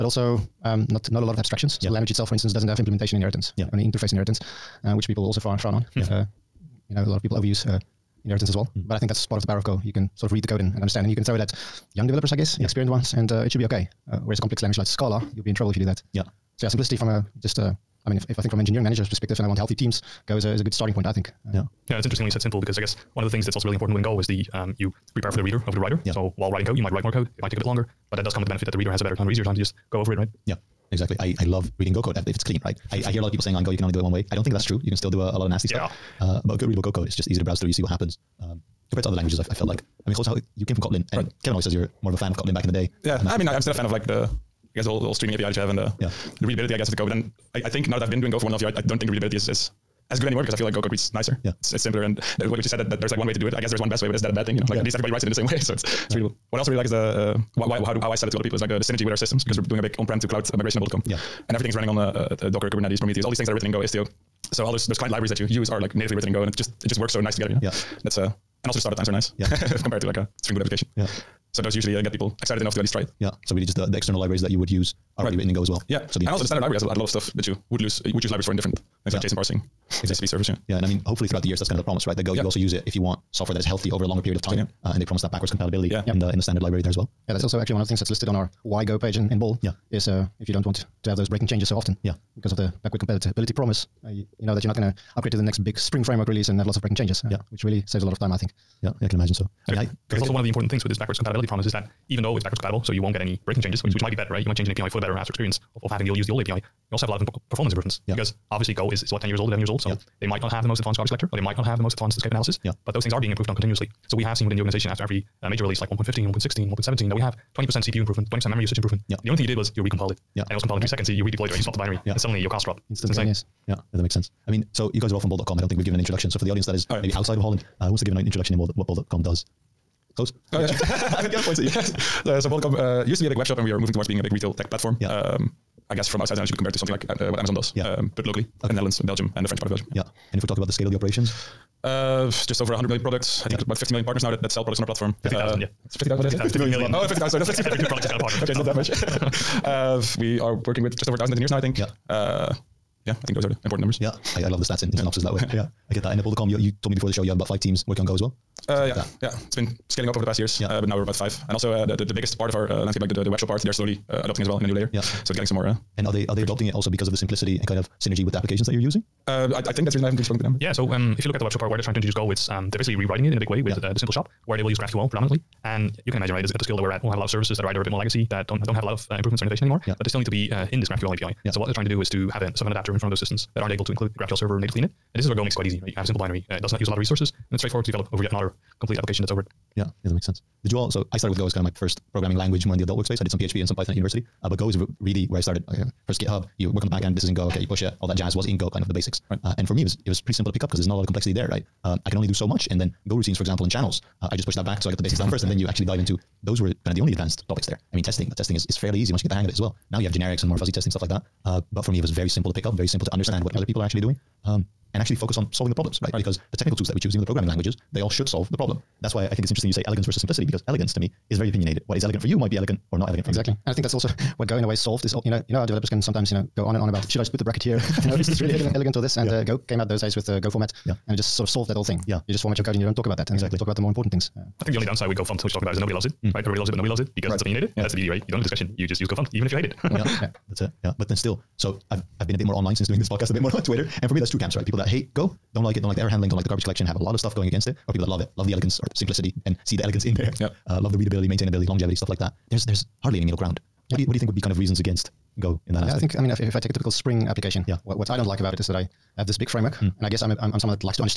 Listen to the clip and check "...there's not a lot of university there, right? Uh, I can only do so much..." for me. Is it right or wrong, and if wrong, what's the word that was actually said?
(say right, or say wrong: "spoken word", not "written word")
wrong: "complexity", not "university".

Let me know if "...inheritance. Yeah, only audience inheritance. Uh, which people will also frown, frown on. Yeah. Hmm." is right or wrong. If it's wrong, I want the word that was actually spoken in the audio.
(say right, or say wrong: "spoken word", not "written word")
wrong: "interface", not "audience".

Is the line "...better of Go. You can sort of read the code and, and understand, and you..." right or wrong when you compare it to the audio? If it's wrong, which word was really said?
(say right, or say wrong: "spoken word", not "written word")
wrong: "power", not "better".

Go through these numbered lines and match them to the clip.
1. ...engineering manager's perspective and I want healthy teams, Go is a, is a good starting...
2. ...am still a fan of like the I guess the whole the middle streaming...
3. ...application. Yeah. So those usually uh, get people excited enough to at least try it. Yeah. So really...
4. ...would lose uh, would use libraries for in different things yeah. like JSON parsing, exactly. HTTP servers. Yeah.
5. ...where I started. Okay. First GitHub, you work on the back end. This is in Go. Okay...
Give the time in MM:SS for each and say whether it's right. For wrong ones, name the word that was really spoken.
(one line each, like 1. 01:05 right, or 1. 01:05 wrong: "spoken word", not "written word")
1. 00:18 right
2. 00:43 wrong: "whole", not "middle"
3. 01:10 right
4. 01:17 right
5. 03:15 right.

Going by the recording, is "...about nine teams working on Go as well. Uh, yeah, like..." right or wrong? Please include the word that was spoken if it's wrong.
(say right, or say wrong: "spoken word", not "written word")
wrong: "five", not "nine".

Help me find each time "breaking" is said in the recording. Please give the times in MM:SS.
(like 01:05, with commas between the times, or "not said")
01:31, 01:36, 01:43.